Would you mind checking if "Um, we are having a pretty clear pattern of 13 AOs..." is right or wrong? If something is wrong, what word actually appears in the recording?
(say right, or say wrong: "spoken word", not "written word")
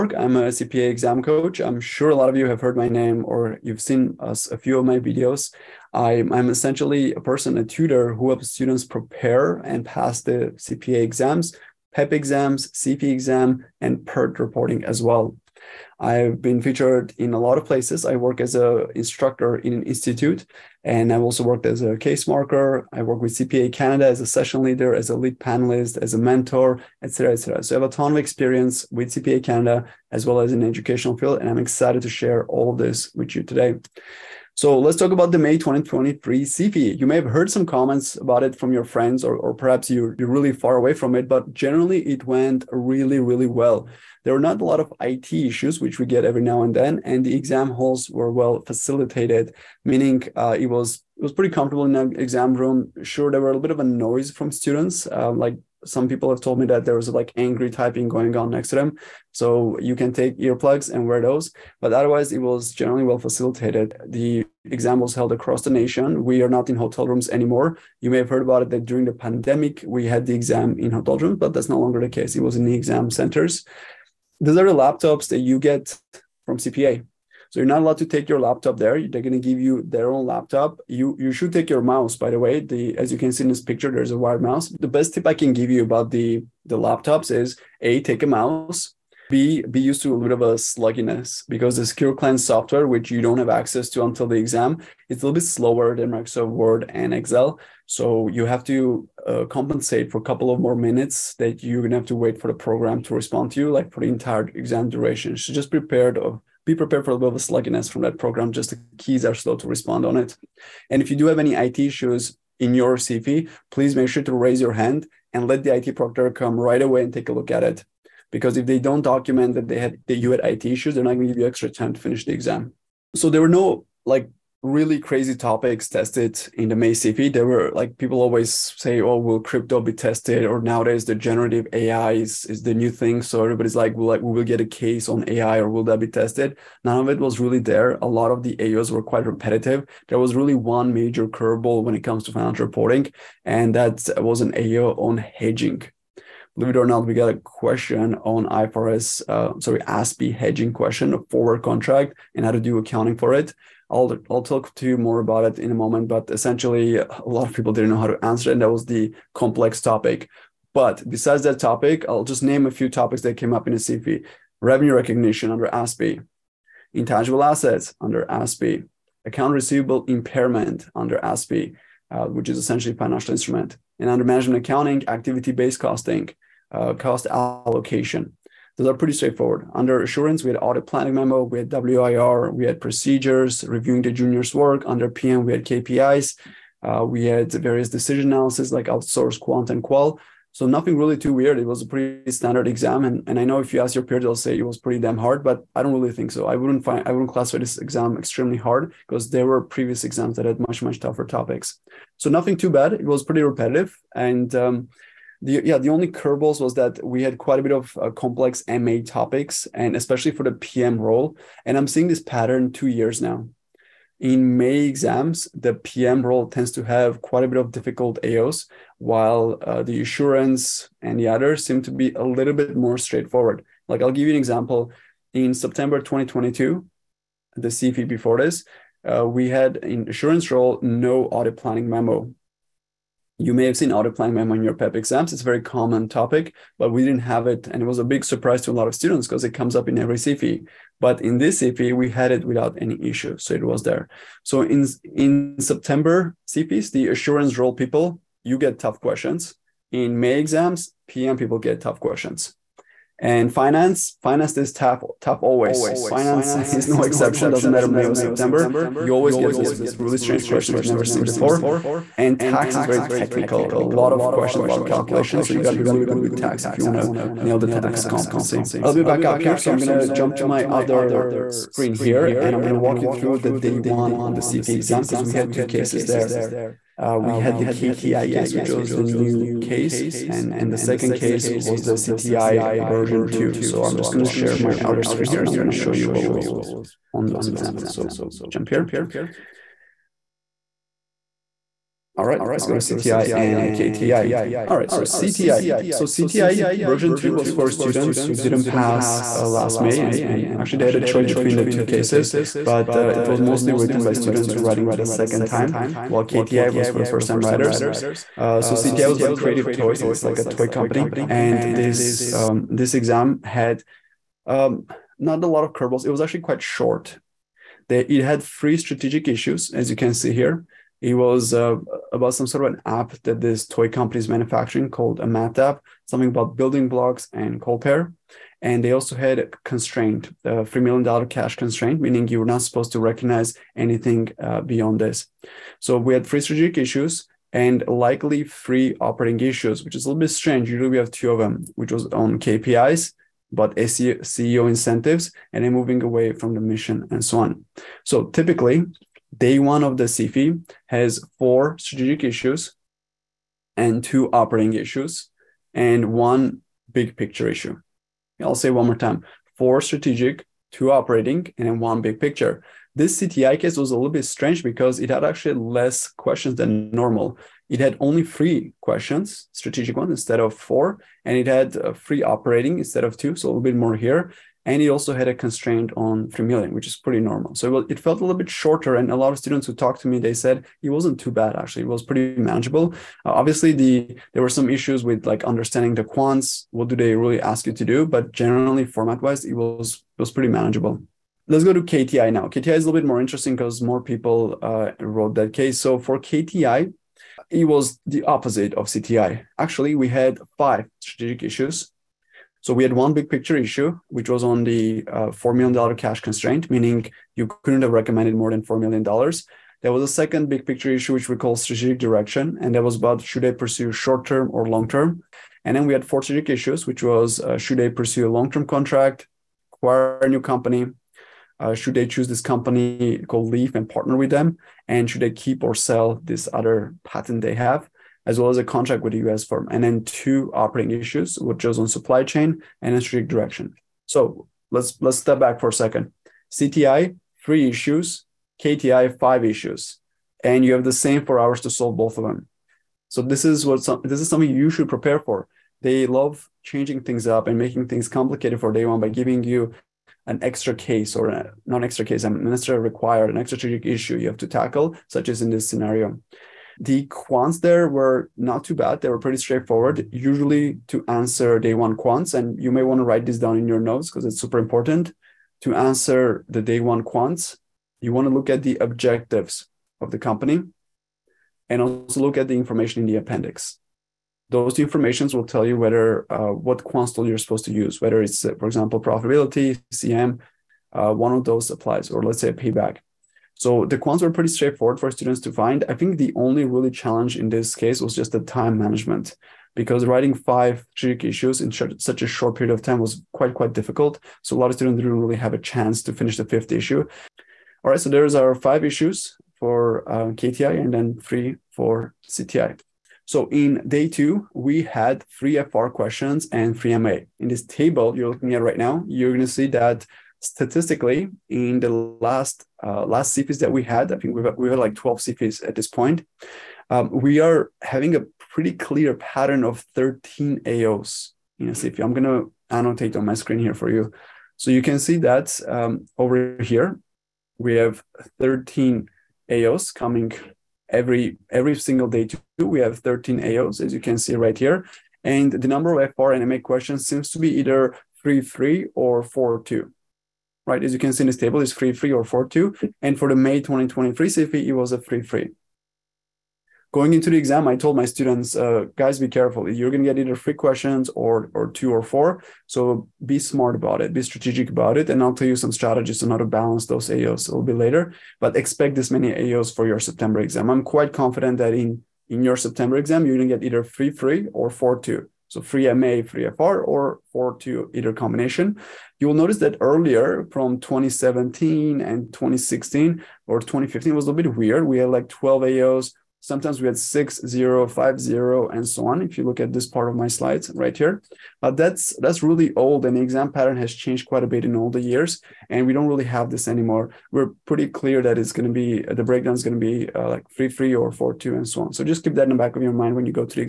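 right.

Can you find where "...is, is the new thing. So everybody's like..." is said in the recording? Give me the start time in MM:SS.
02:12.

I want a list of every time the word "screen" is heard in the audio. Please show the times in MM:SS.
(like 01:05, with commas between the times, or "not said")
04:31, 04:45, 08:43.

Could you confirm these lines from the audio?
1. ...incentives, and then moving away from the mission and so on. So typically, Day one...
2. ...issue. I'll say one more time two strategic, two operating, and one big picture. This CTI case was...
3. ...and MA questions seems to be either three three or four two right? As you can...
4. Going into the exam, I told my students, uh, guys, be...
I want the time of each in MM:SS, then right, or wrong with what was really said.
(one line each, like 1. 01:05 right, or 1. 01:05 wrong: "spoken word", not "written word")
1. 05:44 right
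2. 05:57 wrong: "four", not "two"
3. 08:56 right
4. 09:06 right.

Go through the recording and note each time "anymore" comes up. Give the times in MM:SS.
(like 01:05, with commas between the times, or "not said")
01:07, 09:46.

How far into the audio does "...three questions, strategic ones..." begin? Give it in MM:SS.
06:08.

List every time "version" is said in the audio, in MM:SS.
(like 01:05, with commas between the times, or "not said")
04:42, 04:56.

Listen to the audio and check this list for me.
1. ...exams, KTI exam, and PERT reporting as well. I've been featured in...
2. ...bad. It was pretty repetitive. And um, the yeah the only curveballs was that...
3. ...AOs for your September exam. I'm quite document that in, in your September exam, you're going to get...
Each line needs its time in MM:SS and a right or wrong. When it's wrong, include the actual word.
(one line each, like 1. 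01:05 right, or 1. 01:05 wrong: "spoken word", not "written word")
1. 00:12 wrong: "CFE", not "KTI"
2. 03:22 right
3. 09:19 wrong: "confident", not "document".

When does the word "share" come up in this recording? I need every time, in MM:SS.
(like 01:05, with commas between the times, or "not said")
00:32, 04:44.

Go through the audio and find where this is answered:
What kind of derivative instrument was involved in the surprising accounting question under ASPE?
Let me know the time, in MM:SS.
02:31.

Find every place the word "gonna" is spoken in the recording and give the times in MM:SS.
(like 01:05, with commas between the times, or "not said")
01:41, 08:42.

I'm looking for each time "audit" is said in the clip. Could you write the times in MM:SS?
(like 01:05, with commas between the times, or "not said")
03:00, 03:51.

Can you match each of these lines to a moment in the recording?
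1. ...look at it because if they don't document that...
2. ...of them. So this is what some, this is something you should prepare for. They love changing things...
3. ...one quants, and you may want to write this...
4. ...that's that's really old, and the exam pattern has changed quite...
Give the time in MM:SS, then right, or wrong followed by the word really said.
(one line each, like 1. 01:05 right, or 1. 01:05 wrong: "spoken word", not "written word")
1. 01:57 right
2. 07:22 right
3. 07:41 right
4. 09:41 right.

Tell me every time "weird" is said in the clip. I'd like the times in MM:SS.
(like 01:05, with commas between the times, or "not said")
03:11, 09:34.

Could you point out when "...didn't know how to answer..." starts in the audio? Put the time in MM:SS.
02:37.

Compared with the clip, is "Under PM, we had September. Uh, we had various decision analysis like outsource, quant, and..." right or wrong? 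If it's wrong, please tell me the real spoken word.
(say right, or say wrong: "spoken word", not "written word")
wrong: "KPIs", not "September".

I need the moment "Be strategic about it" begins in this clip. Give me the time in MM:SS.
09:14.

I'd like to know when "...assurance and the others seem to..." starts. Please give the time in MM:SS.
03:40.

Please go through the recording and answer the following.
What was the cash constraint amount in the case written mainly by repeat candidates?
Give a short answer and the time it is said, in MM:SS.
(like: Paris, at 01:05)
$3 million, at 05:30.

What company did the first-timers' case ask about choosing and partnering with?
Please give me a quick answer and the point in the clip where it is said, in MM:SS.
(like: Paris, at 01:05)
Leaf, at 07:03.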